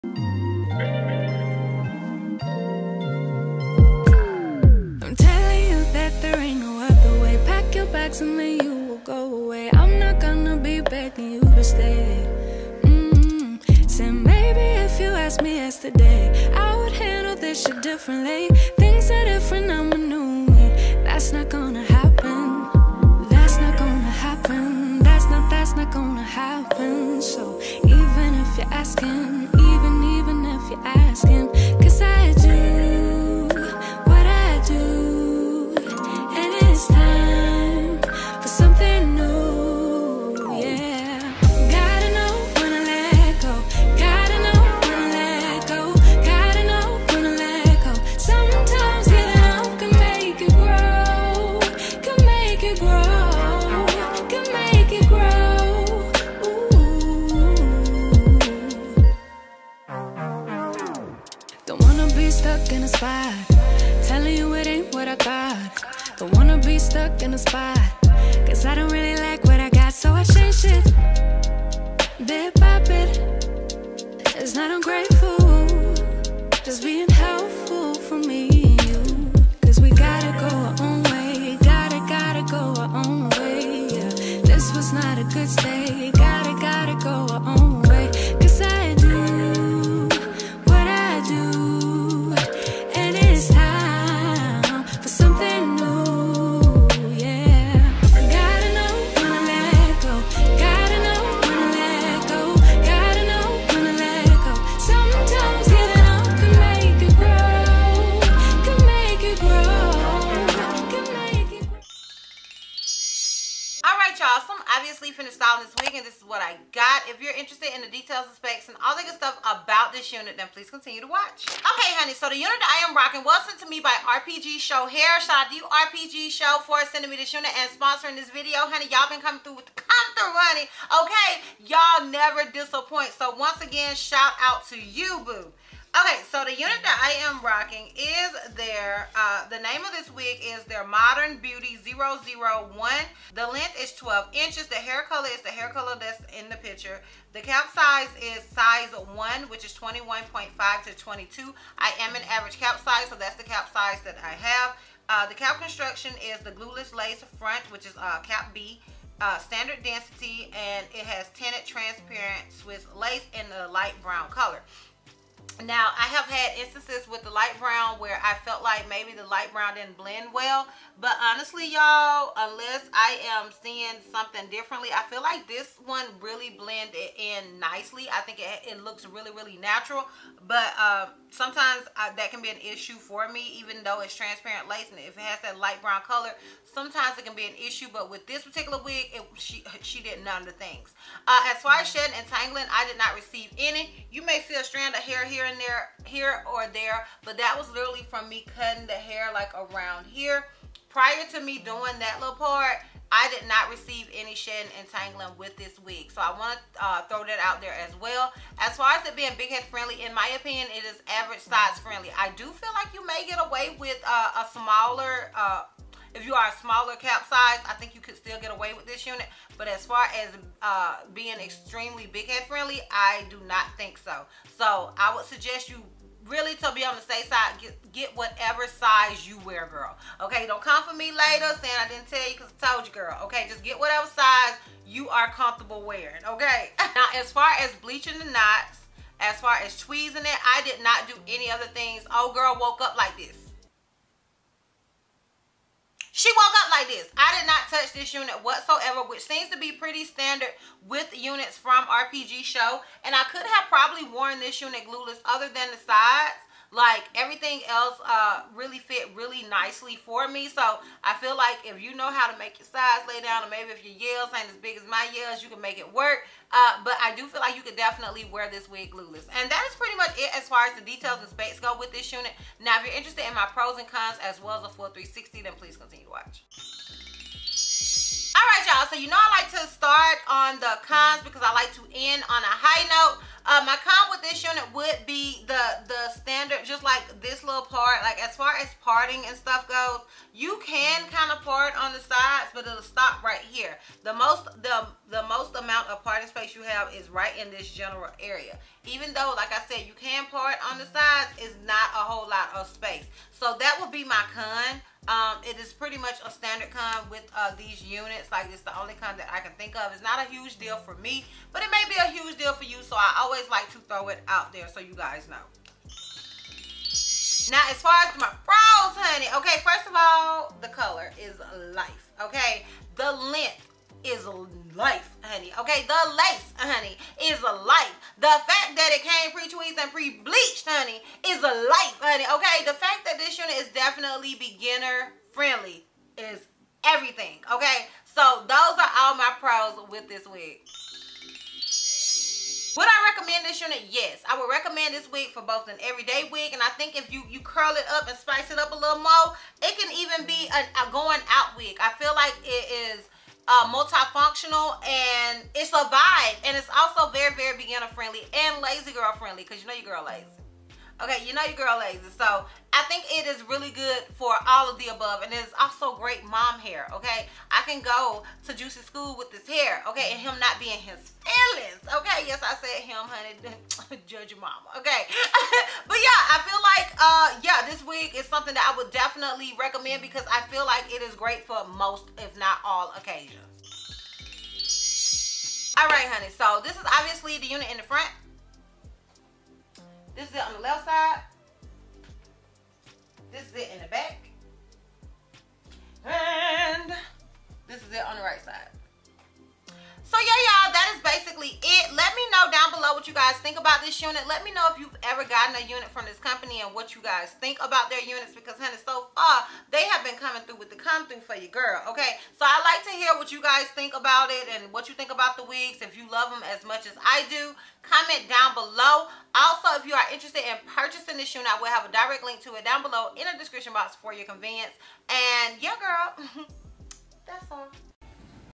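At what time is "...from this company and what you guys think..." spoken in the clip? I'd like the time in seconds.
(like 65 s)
405 s.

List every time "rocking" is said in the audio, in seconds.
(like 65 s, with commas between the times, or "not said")
122 s, 137 s.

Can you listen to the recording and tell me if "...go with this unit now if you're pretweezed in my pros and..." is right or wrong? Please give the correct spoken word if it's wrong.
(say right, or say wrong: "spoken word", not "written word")
wrong: "interested", not "pretweezed".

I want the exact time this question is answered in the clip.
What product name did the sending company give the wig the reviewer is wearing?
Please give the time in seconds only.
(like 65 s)
140 s.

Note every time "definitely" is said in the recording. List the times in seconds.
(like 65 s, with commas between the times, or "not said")
267 s, 333 s, 378 s.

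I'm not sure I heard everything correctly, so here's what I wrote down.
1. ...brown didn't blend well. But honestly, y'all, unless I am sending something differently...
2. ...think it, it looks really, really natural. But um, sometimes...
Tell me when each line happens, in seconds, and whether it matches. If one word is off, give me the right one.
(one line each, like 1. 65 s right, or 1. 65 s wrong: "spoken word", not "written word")
1. 169 s wrong: "seeing", not "sending"
2. 178 s right.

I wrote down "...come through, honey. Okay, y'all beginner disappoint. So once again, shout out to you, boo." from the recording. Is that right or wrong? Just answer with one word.
wrong.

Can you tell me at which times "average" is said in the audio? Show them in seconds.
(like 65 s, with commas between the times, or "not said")
152 s, 211 s.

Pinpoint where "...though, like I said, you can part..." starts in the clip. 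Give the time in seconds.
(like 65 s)
299 s.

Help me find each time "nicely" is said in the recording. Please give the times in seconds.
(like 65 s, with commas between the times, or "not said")
177 s, 259 s.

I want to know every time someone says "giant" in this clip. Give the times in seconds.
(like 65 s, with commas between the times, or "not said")
not said.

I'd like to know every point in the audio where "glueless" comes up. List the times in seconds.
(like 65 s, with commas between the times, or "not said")
156 s, 254 s, 268 s.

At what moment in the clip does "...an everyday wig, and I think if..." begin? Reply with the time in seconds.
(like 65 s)
345 s.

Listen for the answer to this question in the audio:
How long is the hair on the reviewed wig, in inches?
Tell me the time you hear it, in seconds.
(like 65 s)
143 s.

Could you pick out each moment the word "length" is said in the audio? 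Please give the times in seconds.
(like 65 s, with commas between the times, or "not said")
143 s, 323 s.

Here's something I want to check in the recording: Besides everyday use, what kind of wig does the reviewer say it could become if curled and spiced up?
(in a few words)
going out wig.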